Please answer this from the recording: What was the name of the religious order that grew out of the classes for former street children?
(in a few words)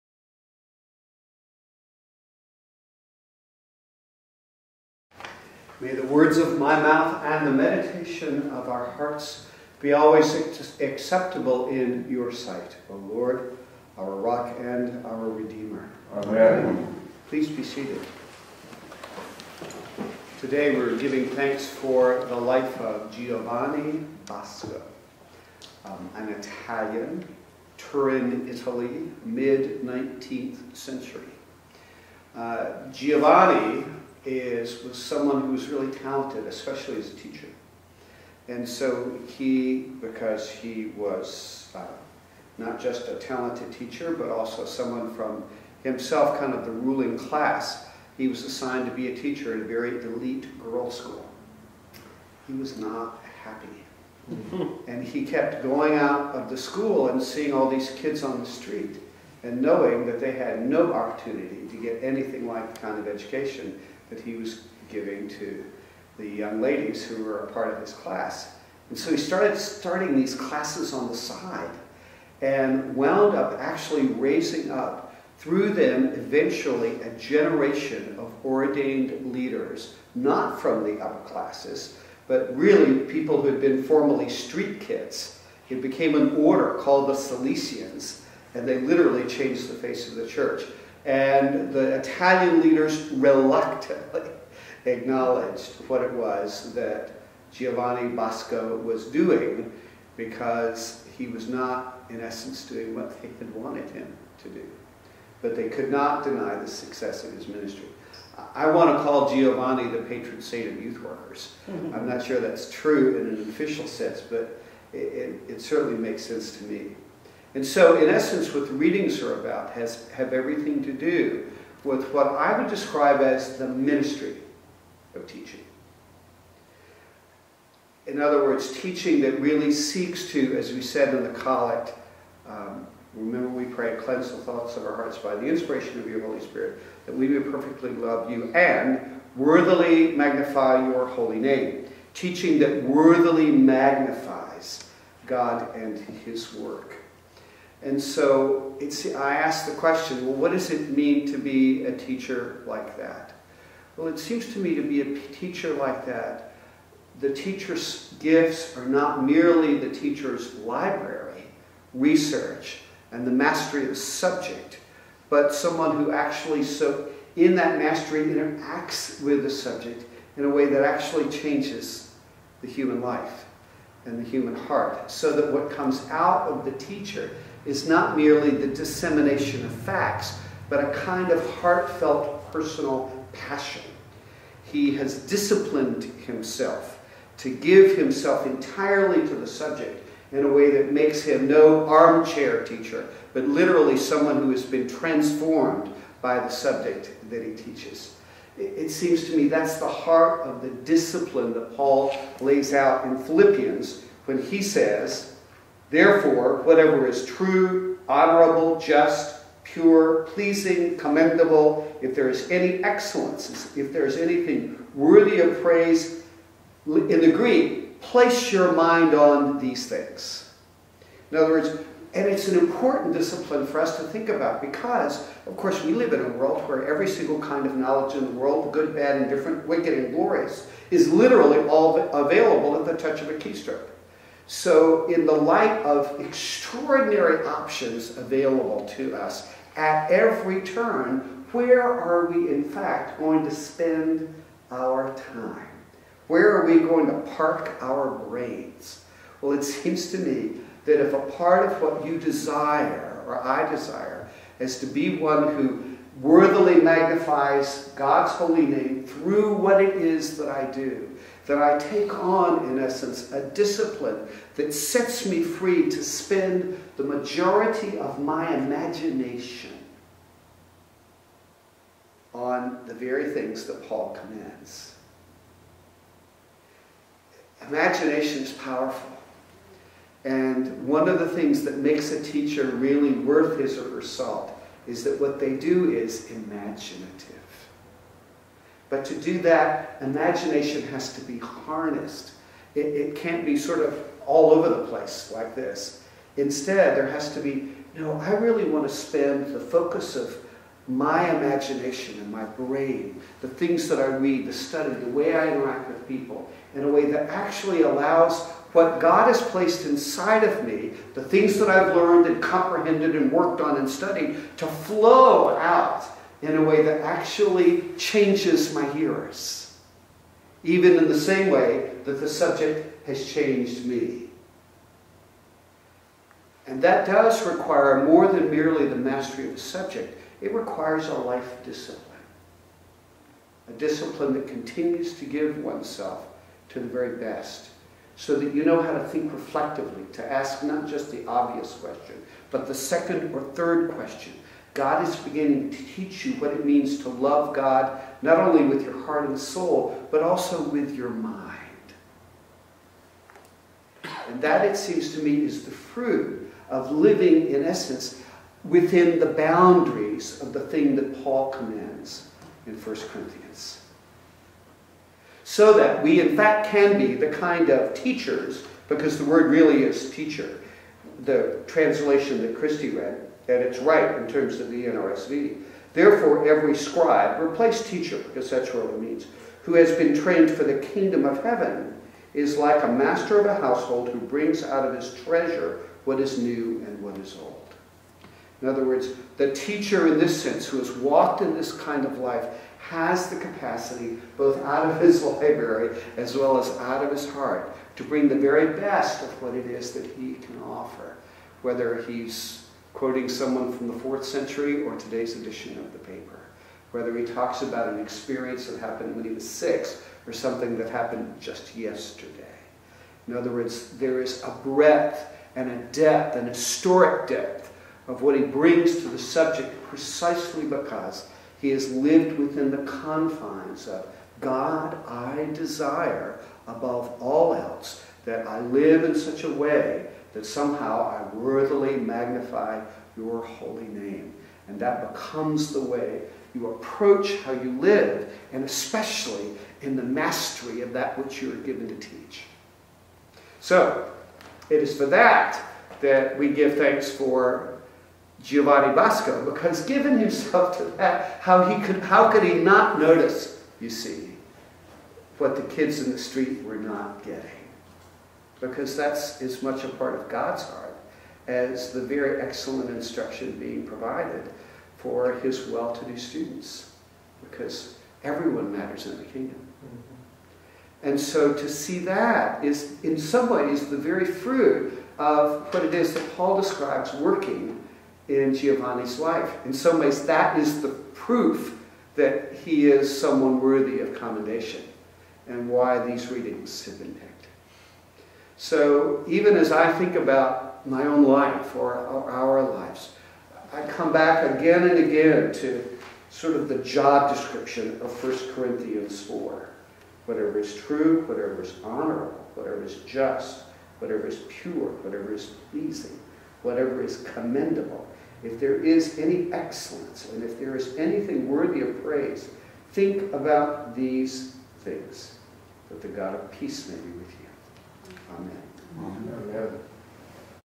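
Salesians.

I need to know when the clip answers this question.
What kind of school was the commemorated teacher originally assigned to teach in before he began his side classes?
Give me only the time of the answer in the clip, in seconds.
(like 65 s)
50 s.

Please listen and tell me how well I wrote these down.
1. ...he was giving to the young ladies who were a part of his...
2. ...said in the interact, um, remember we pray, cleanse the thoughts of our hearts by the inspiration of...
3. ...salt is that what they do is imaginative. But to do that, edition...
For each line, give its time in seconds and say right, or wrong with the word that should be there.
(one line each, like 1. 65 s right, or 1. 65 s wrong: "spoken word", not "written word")
1. 64 s right
2. 130 s wrong: "collect", not "interact"
3. 284 s wrong: "imagination", not "edition".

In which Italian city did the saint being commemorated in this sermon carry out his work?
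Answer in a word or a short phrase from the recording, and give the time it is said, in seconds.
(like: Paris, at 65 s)
Turin, at 27 s.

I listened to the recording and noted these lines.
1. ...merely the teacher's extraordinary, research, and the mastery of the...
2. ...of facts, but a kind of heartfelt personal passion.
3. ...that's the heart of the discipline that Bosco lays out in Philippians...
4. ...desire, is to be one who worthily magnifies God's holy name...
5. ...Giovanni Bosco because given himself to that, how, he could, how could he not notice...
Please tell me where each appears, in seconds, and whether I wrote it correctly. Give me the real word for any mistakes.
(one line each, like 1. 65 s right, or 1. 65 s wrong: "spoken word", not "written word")
1. 159 s wrong: "library", not "extraordinary"
2. 179 s right
3. 199 s wrong: "Paul", not "Bosco"
4. 253 s right
5. 448 s right.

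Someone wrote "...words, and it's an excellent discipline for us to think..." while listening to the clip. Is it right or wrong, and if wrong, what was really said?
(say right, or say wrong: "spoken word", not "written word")
wrong: "important", not "excellent".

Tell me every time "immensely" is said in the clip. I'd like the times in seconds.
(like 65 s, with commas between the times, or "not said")
not said.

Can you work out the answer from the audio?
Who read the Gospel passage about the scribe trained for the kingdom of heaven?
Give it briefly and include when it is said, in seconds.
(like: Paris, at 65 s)
Christie, at 372 s.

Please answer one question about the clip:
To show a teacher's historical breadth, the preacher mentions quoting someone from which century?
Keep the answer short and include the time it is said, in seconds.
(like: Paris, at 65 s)
4th century, at 403 s.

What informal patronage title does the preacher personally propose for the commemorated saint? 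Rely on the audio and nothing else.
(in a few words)
Patron saint of youth workers.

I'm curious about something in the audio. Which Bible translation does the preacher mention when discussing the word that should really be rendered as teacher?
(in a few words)
NRSV.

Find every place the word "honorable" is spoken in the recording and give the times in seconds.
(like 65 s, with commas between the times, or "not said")
208 s, 501 s.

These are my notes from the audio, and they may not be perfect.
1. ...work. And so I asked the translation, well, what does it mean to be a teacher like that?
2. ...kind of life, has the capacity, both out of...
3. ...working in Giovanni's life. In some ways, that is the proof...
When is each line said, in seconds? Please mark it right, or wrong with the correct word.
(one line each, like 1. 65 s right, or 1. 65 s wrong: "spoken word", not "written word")
1. 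146 s wrong: "question", not "translation"
2. 391 s right
3. 477 s right.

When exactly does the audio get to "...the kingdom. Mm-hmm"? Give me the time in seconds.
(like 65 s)
469 s.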